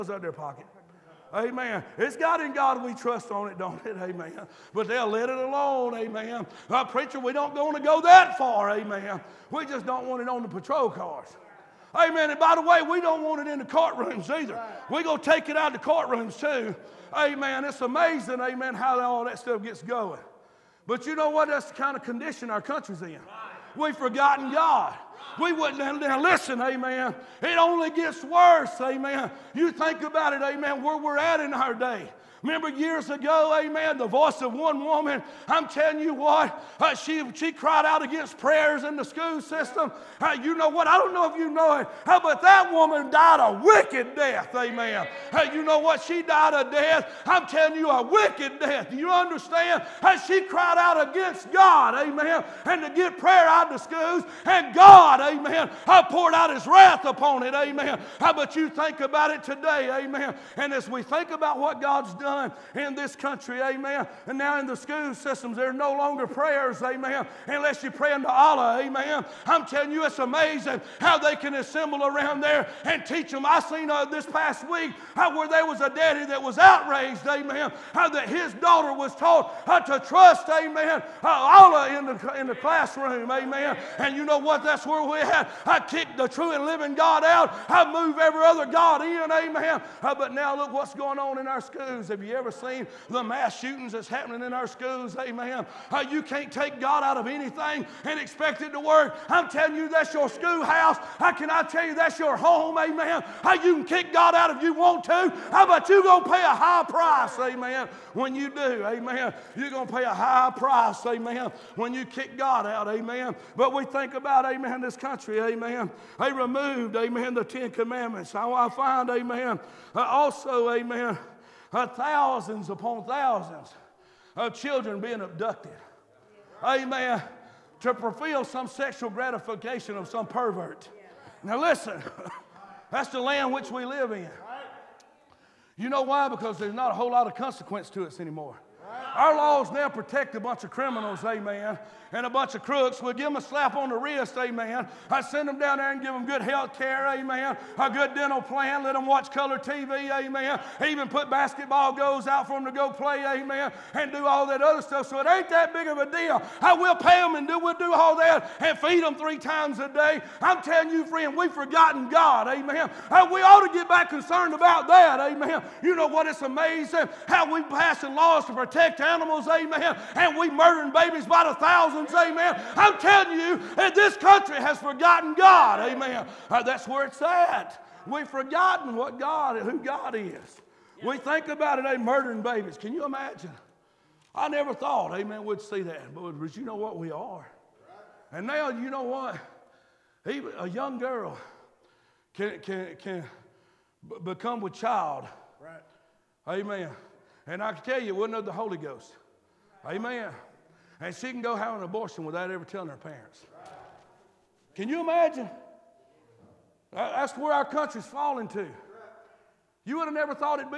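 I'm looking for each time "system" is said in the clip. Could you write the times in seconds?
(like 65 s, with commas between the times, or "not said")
39 s, 65 s.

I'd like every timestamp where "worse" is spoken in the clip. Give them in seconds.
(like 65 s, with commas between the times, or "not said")
28 s.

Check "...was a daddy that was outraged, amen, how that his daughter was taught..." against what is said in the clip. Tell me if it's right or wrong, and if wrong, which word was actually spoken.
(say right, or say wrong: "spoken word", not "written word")
right.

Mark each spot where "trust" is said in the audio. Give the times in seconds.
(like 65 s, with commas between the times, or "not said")
2 s, 80 s.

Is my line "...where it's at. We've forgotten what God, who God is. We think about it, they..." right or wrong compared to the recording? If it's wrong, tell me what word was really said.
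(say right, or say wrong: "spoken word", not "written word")
right.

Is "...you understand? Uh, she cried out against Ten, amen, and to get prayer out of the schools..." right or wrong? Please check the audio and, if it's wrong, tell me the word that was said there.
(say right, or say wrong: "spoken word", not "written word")
wrong: "God", not "Ten".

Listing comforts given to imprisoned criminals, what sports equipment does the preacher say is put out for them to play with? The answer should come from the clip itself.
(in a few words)
Basketball goals.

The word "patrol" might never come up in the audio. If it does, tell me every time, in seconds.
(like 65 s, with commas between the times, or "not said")
10 s.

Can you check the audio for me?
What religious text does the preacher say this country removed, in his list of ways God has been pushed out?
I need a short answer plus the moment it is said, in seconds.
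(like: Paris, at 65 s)
The Ten Commandments, at 117 s.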